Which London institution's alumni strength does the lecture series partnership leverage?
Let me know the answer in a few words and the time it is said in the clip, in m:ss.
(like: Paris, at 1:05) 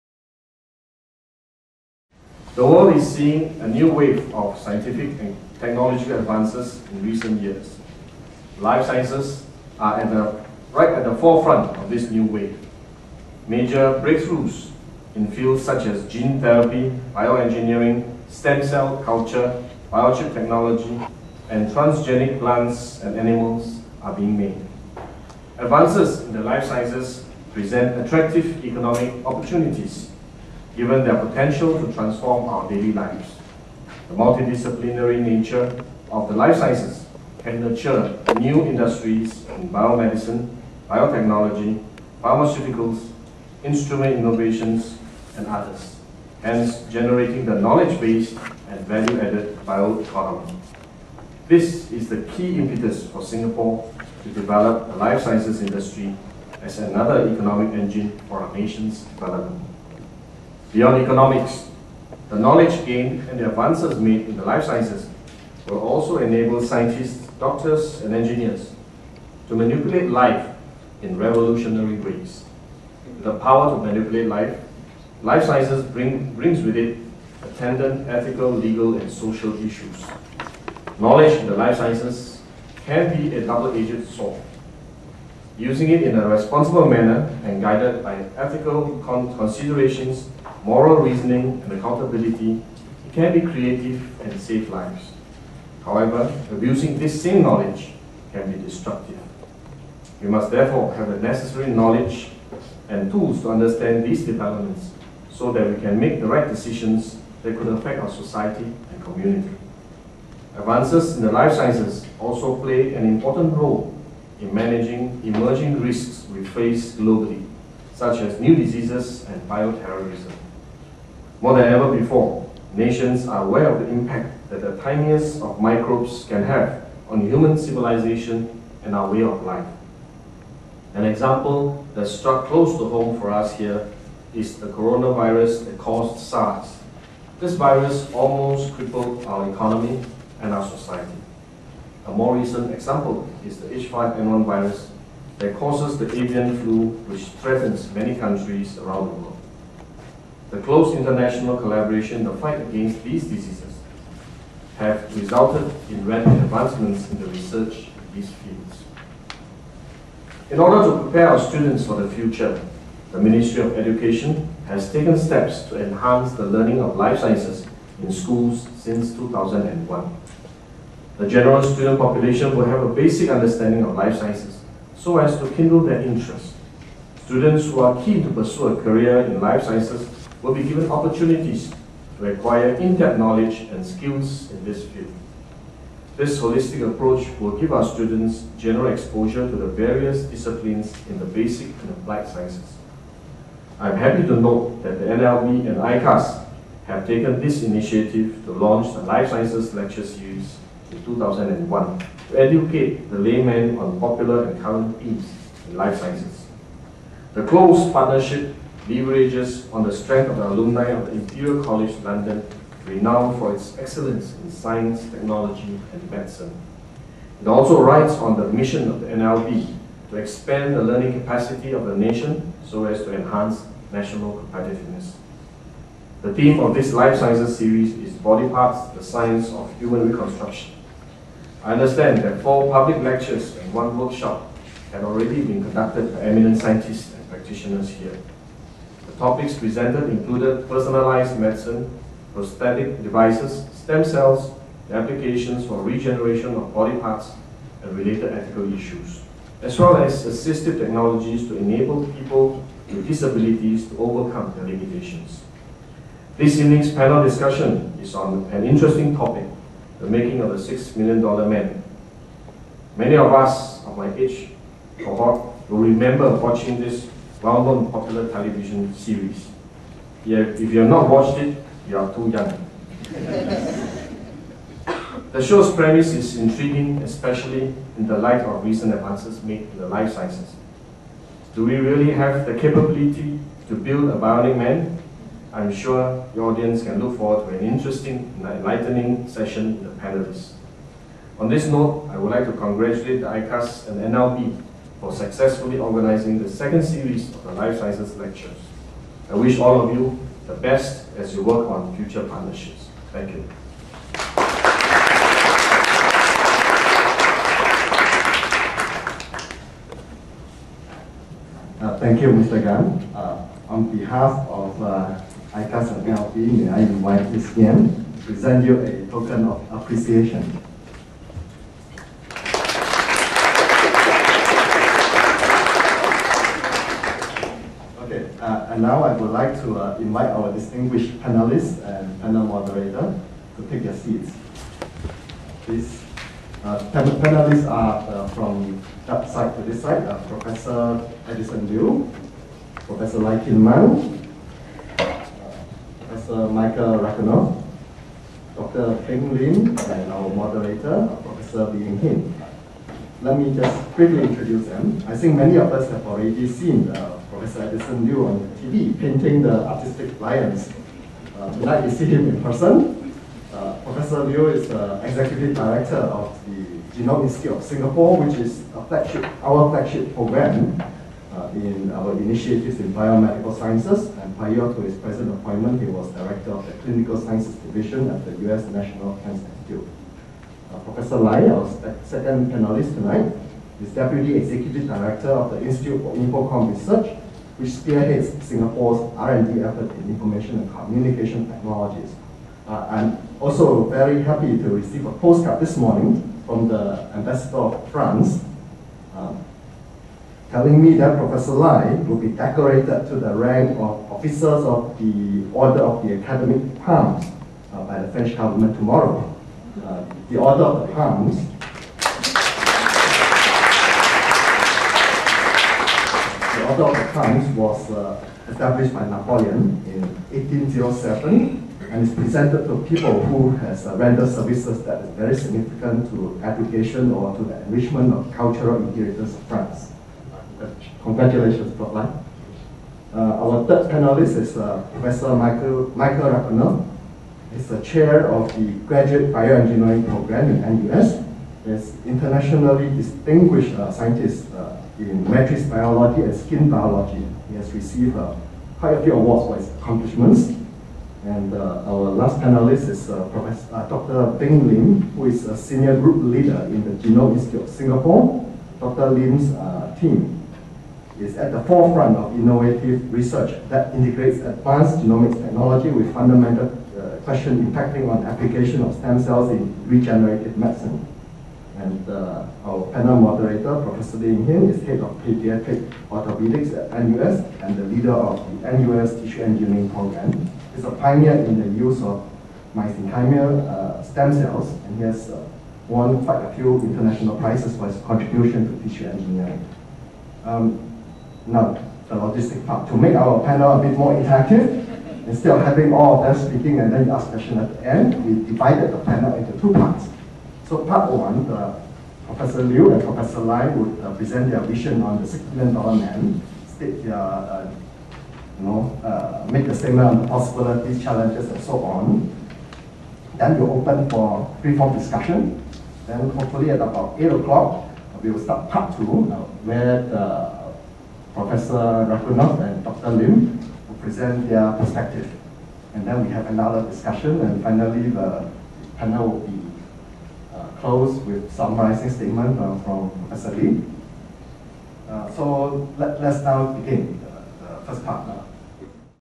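Imperial College London, at 3:31.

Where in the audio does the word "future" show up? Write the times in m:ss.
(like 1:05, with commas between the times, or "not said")
2:42, 5:01.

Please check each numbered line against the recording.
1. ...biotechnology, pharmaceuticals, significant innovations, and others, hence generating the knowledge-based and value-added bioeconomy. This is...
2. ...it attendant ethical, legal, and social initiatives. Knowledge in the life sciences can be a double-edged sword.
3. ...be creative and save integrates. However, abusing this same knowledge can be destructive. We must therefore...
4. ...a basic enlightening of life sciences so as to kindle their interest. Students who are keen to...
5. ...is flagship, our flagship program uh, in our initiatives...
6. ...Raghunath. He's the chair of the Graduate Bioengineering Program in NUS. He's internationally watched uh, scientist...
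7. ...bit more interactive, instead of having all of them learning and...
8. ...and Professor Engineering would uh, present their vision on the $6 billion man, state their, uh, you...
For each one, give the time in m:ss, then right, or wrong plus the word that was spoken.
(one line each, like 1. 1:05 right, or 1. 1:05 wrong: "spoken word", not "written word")
1. 0:40 wrong: "instrument", not "significant"
2. 1:16 wrong: "issues", not "initiatives"
3. 1:33 wrong: "lives", not "integrates"
4. 2:52 wrong: "understanding", not "enlightening"
5. 6:08 right
6. 7:16 wrong: "distinguished", not "watched"
7. 8:13 wrong: "speaking", not "learning"
8. 8:22 wrong: "Lai", not "Engineering".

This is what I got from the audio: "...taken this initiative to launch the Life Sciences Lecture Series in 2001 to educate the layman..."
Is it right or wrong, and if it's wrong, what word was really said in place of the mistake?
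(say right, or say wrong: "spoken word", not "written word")
right.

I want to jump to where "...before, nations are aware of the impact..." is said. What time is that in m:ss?
2:01.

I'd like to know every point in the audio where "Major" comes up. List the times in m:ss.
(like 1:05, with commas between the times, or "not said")
0:13.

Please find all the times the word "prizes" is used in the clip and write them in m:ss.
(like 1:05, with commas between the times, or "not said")
8:07.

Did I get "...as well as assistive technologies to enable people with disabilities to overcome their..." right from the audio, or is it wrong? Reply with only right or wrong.
right.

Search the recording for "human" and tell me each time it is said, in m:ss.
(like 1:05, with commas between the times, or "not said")
2:07, 3:49.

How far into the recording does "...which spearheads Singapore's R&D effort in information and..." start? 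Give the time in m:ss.
6:27.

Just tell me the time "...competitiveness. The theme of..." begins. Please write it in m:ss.
3:44.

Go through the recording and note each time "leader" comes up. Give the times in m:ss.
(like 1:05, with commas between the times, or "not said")
7:36, 7:57.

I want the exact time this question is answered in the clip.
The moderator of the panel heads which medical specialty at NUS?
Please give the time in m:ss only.
7:55.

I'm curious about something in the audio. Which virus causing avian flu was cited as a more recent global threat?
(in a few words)
H5N1.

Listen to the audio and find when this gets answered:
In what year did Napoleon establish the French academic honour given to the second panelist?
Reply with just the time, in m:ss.
7:00.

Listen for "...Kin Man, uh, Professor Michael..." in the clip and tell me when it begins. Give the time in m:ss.
5:43.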